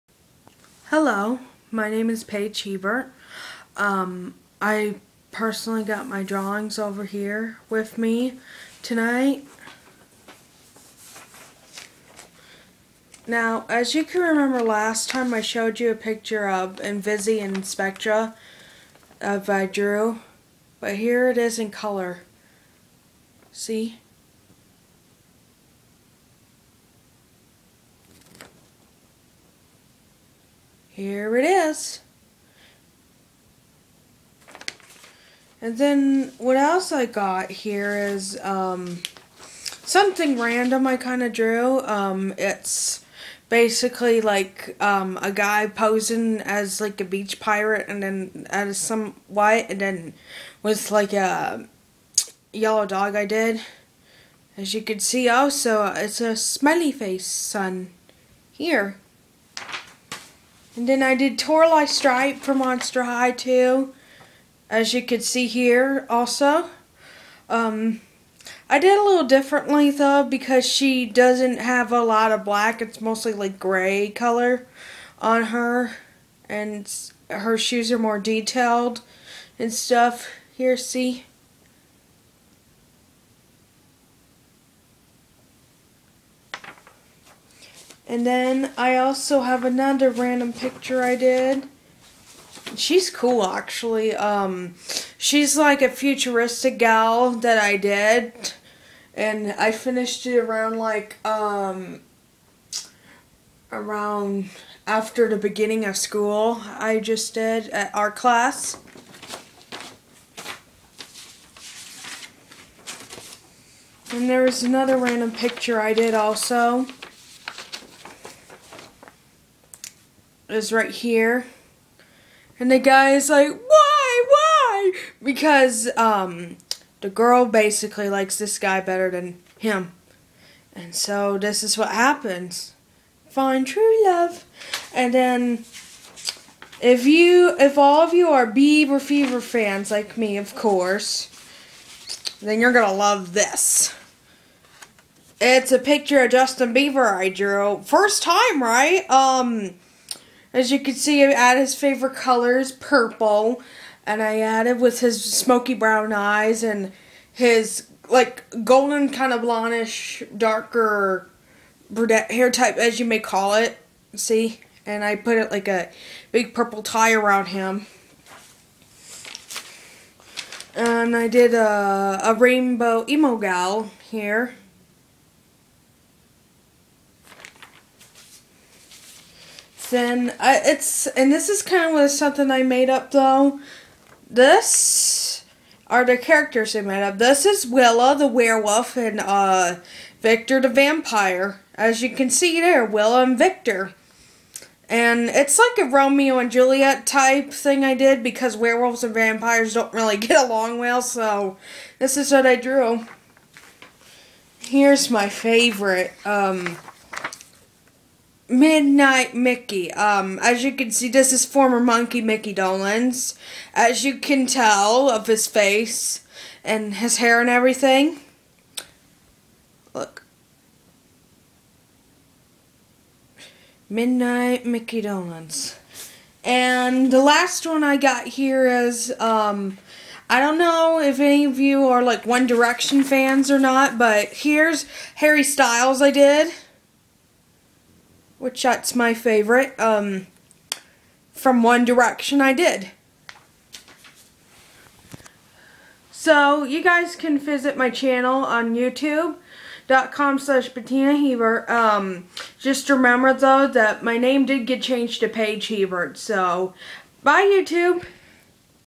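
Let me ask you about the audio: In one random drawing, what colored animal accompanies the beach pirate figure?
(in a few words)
Yellow dog.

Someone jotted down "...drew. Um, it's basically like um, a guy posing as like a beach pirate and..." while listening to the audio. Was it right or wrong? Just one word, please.
right.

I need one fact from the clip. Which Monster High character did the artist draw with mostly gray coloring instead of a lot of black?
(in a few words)
Toralei Stripe.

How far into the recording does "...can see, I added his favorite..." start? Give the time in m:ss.
2:30.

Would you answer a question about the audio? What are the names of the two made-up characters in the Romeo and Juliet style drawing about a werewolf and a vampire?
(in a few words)
Willa and Victor.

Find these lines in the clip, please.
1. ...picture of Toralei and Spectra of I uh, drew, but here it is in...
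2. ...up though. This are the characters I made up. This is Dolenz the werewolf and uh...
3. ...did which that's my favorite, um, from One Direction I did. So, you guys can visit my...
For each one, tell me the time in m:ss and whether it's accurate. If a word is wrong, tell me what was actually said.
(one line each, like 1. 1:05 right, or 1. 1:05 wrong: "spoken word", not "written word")
1. 0:15 wrong: "Invisi", not "Toralei"
2. 3:02 wrong: "Willa", not "Dolenz"
3. 3:56 right.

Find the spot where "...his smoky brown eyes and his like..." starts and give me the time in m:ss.
2:34.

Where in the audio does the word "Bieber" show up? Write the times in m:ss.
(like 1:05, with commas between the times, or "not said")
2:18, 2:26.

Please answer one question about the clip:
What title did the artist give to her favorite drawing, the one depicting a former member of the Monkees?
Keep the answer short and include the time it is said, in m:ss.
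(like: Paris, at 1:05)
Midnight Mickey, at 3:28.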